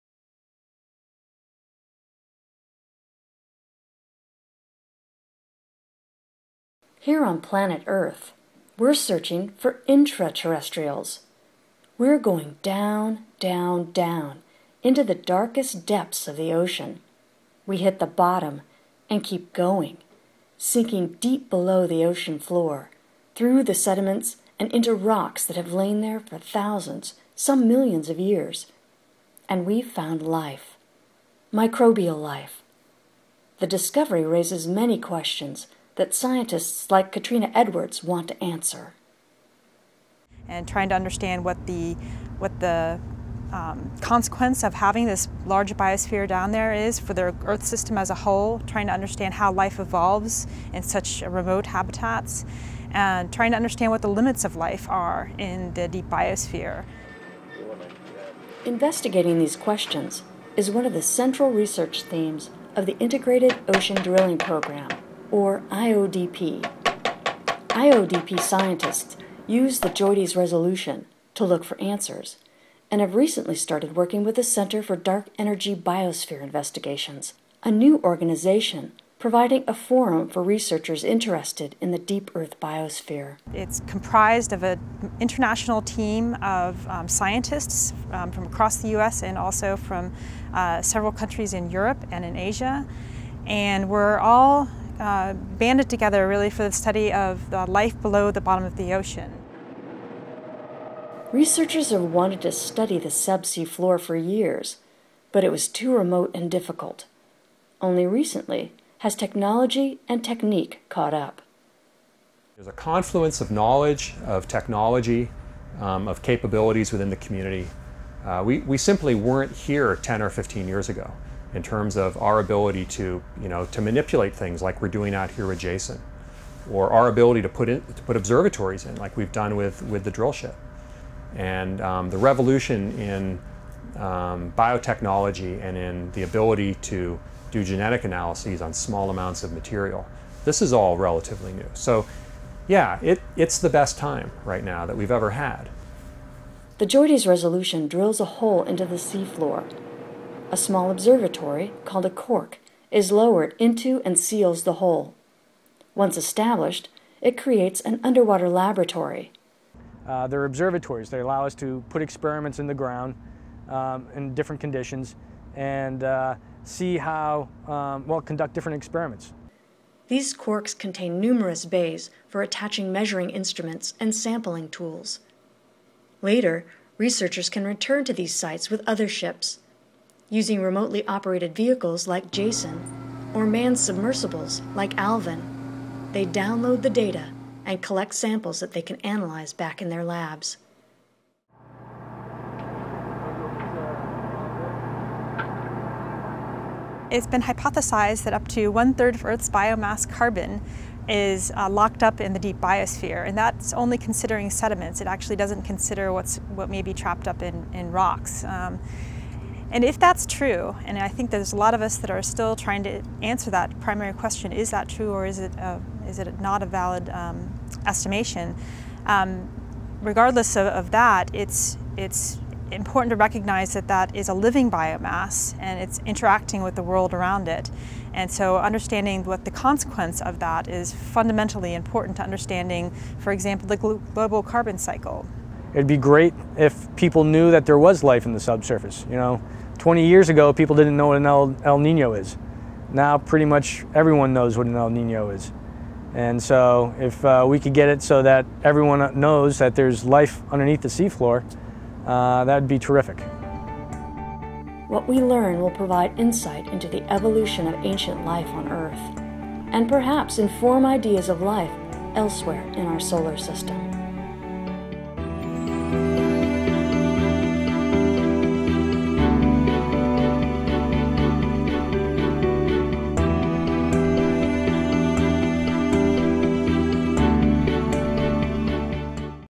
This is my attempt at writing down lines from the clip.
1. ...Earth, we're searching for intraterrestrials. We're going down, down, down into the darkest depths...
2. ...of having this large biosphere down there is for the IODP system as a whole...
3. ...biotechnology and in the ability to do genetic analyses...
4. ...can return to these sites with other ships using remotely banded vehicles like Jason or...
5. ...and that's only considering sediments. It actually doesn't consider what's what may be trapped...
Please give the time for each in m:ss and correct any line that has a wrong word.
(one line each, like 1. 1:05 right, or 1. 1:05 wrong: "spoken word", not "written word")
1. 0:07 right
2. 0:44 wrong: "Earth", not "IODP"
3. 2:14 right
4. 2:57 wrong: "operated", not "banded"
5. 3:23 right.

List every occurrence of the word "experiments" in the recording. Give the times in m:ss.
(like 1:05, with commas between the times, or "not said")
2:42, 2:48.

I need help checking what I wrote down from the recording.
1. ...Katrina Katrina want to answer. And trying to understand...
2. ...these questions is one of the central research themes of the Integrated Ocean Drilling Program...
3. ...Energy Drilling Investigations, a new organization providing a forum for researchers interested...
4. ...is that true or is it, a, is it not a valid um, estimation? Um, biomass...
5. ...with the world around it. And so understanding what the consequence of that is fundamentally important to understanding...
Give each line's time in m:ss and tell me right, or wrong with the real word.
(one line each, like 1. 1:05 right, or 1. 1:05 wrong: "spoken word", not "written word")
1. 0:37 wrong: "Edwards", not "Katrina"
2. 0:59 right
3. 1:15 wrong: "Biosphere", not "Drilling"
4. 3:34 wrong: "regardless", not "biomass"
5. 3:46 right.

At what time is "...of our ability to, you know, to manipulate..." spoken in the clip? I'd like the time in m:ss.
2:01.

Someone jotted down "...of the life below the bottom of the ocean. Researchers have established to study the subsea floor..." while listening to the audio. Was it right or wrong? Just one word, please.
wrong.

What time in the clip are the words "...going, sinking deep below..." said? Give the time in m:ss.
0:19.